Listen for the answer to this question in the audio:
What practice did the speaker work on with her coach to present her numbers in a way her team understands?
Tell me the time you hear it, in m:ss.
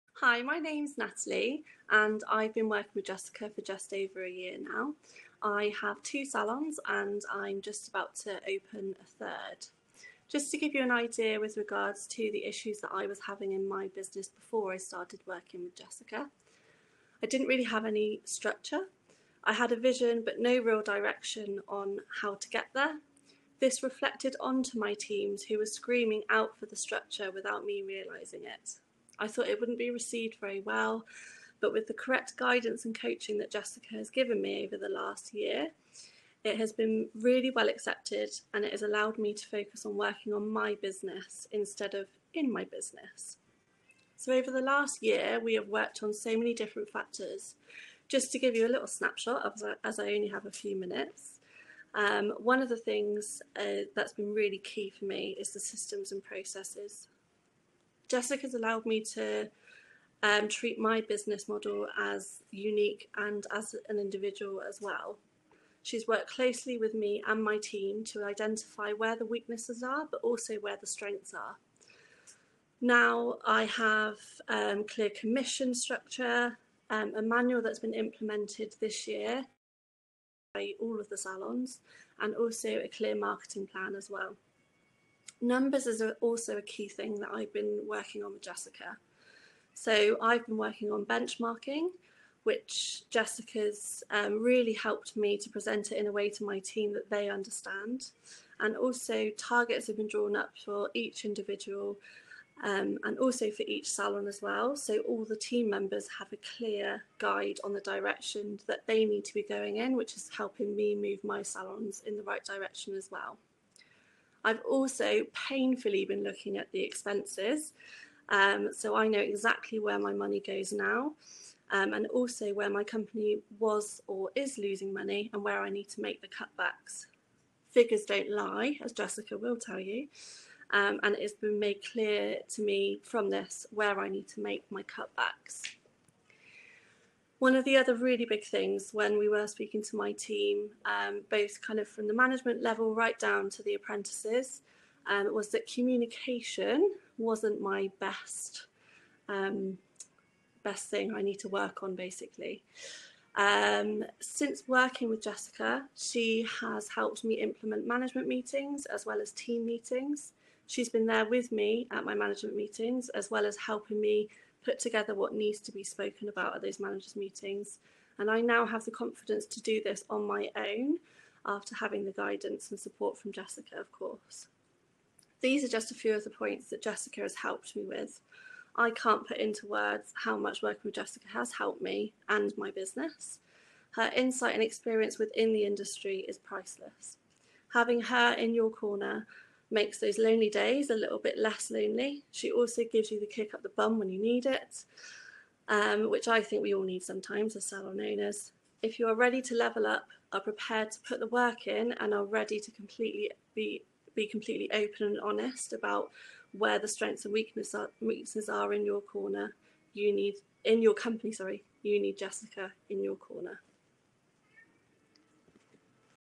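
1:31.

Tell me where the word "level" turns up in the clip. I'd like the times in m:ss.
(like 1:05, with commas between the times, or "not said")
2:22, 3:19.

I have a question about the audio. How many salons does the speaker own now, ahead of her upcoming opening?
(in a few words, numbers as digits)
2.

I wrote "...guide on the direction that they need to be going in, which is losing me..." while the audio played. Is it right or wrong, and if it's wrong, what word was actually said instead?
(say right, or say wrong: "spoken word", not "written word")
wrong: "helping", not "losing".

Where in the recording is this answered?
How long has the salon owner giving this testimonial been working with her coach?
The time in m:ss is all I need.
0:03.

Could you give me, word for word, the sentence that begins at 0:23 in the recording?
This reflected onto my teams who were screaming out for the structure without me realising it.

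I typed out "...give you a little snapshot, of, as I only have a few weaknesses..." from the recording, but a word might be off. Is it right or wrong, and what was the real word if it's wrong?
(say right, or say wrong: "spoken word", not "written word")
wrong: "minutes", not "weaknesses".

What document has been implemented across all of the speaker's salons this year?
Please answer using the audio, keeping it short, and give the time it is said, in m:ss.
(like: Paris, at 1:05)
a manual, at 1:17.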